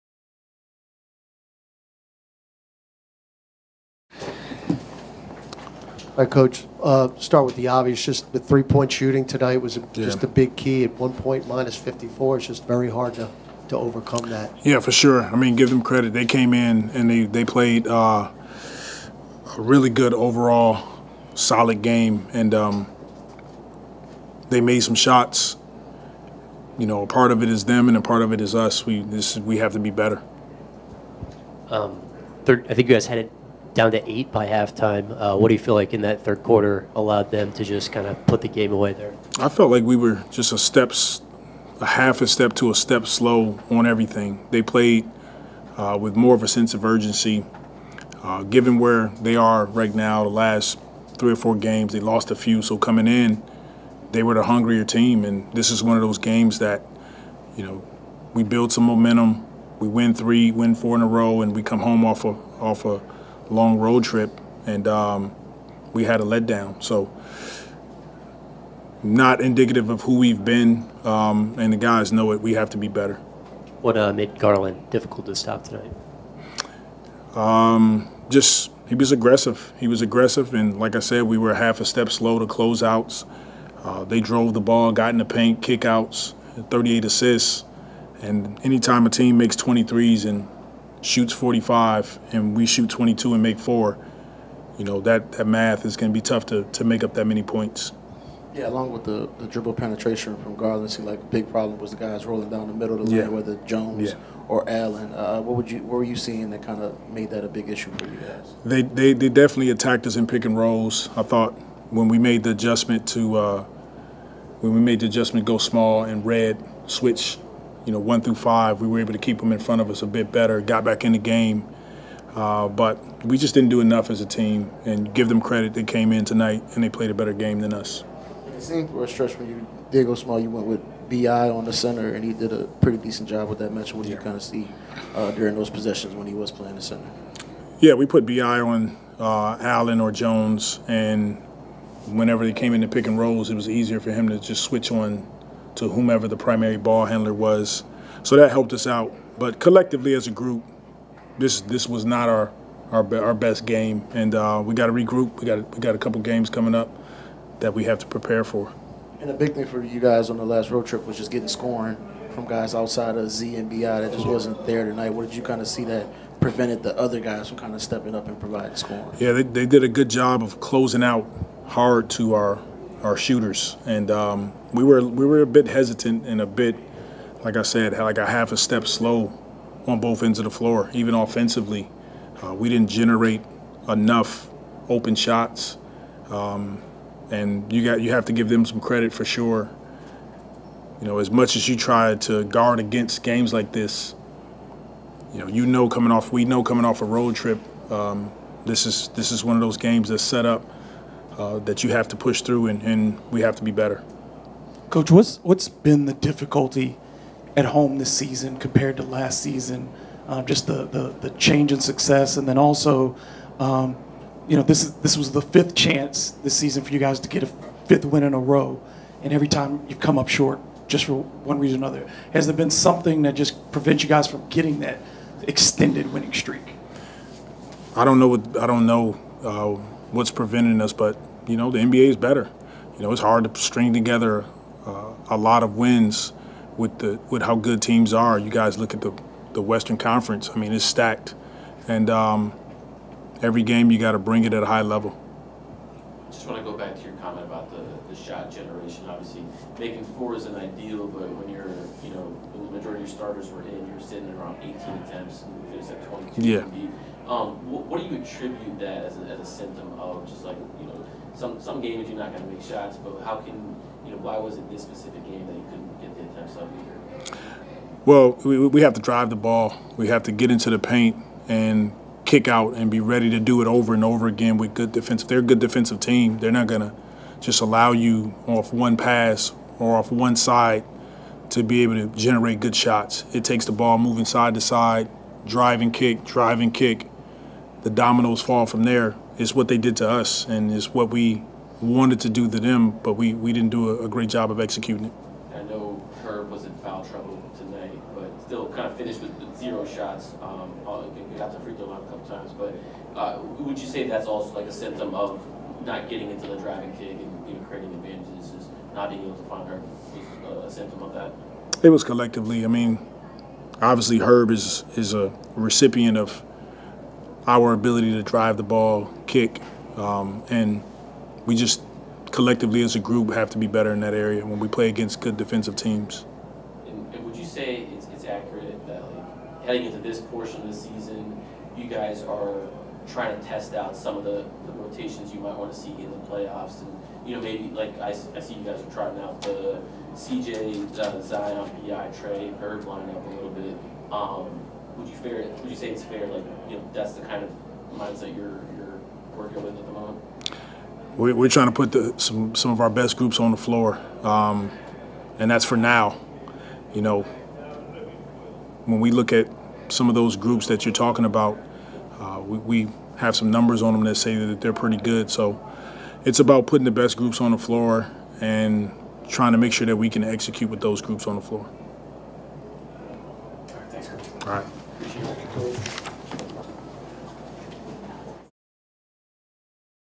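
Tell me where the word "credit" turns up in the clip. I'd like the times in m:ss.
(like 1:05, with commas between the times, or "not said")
0:15, 2:05, 3:08.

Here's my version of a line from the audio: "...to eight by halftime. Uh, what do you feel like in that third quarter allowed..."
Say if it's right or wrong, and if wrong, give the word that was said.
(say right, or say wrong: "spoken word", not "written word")
right.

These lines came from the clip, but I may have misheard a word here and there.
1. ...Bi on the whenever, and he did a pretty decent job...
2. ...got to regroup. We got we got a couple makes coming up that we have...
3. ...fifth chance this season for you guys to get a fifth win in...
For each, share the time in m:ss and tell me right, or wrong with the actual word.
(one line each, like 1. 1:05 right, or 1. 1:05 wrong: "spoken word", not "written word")
1. 2:11 wrong: "center", not "whenever"
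2. 2:34 wrong: "games", not "makes"
3. 3:35 right.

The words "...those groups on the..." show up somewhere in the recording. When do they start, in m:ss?
6:10.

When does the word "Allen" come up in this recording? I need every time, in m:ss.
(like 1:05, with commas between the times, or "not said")
1:44, 2:19.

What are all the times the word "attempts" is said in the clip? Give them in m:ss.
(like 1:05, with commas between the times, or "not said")
4:15, 4:26.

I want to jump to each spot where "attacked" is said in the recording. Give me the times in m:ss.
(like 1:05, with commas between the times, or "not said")
1:49.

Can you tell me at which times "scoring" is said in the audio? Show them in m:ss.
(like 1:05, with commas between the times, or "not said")
2:41, 2:48.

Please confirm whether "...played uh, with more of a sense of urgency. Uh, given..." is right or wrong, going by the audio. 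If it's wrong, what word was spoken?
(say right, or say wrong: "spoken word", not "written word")
right.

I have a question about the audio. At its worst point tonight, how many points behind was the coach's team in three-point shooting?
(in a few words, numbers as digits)
54.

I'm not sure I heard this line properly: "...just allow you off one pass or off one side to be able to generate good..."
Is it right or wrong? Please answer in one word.
right.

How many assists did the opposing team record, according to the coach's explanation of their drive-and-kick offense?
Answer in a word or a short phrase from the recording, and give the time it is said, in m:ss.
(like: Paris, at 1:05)
38, at 1:26.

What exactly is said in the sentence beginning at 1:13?
What uh, made Garland difficult to stop tonight?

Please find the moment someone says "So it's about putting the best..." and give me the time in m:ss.
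6:05.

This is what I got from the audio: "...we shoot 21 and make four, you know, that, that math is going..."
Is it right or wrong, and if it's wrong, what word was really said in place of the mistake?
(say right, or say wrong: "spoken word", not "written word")
wrong: "22", not "21".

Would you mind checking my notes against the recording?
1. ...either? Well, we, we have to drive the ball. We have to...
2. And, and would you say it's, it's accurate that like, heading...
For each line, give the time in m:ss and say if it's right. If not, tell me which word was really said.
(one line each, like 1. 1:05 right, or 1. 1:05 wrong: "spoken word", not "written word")
1. 4:26 right
2. 5:26 right.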